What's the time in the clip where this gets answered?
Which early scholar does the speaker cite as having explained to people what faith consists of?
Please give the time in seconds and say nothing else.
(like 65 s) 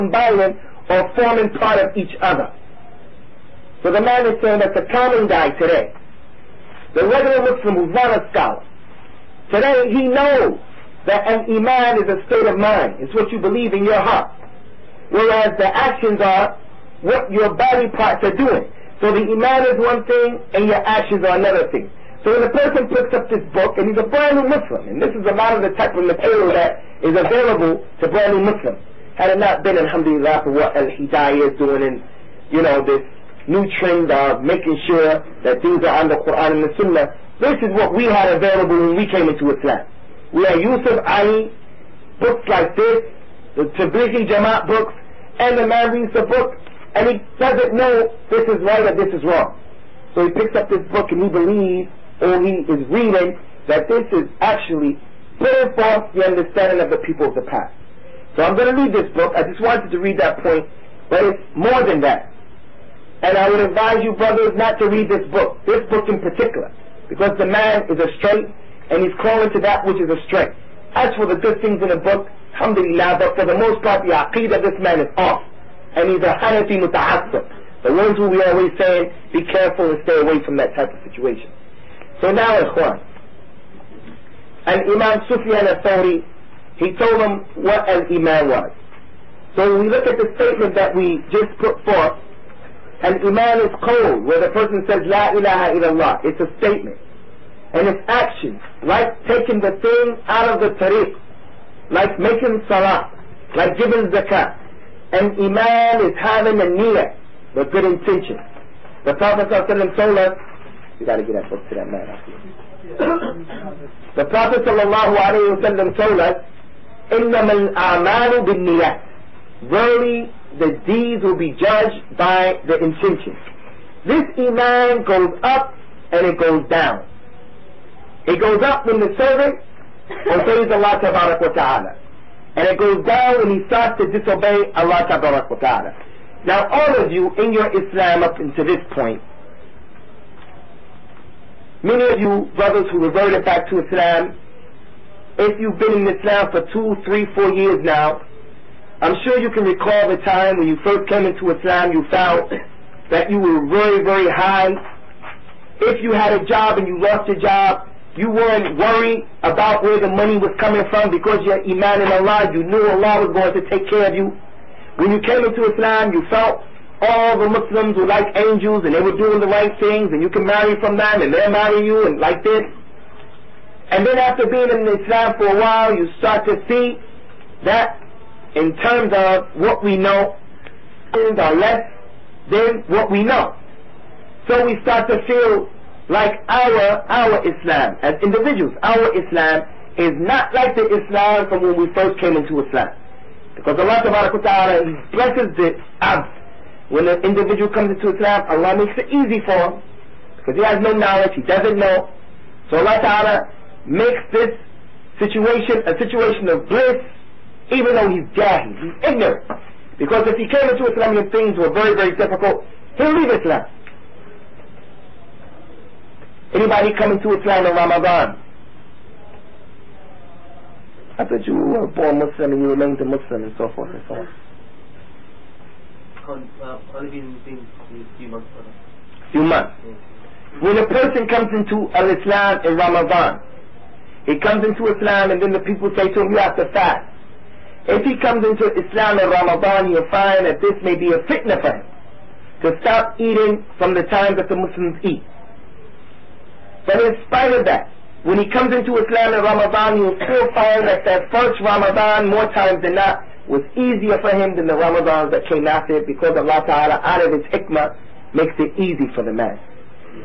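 85 s.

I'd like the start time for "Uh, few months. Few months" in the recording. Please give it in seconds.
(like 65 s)
226 s.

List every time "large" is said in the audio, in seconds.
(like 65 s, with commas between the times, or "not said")
not said.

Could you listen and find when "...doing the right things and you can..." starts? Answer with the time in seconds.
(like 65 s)
169 s.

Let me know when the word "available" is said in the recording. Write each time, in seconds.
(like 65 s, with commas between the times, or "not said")
27 s, 38 s.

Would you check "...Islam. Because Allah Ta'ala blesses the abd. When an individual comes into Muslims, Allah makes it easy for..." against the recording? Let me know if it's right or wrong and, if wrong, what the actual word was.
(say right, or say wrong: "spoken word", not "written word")
wrong: "Islam", not "Muslims".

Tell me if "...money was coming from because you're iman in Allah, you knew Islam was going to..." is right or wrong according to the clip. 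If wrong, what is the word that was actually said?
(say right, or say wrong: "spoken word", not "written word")
wrong: "Allah", not "Islam".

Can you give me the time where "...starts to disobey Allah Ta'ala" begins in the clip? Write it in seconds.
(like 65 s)
133 s.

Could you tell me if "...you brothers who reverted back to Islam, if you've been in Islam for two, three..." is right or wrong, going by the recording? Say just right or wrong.
right.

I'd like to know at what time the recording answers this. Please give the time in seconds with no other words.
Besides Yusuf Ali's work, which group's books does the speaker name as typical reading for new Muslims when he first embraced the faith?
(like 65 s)
43 s.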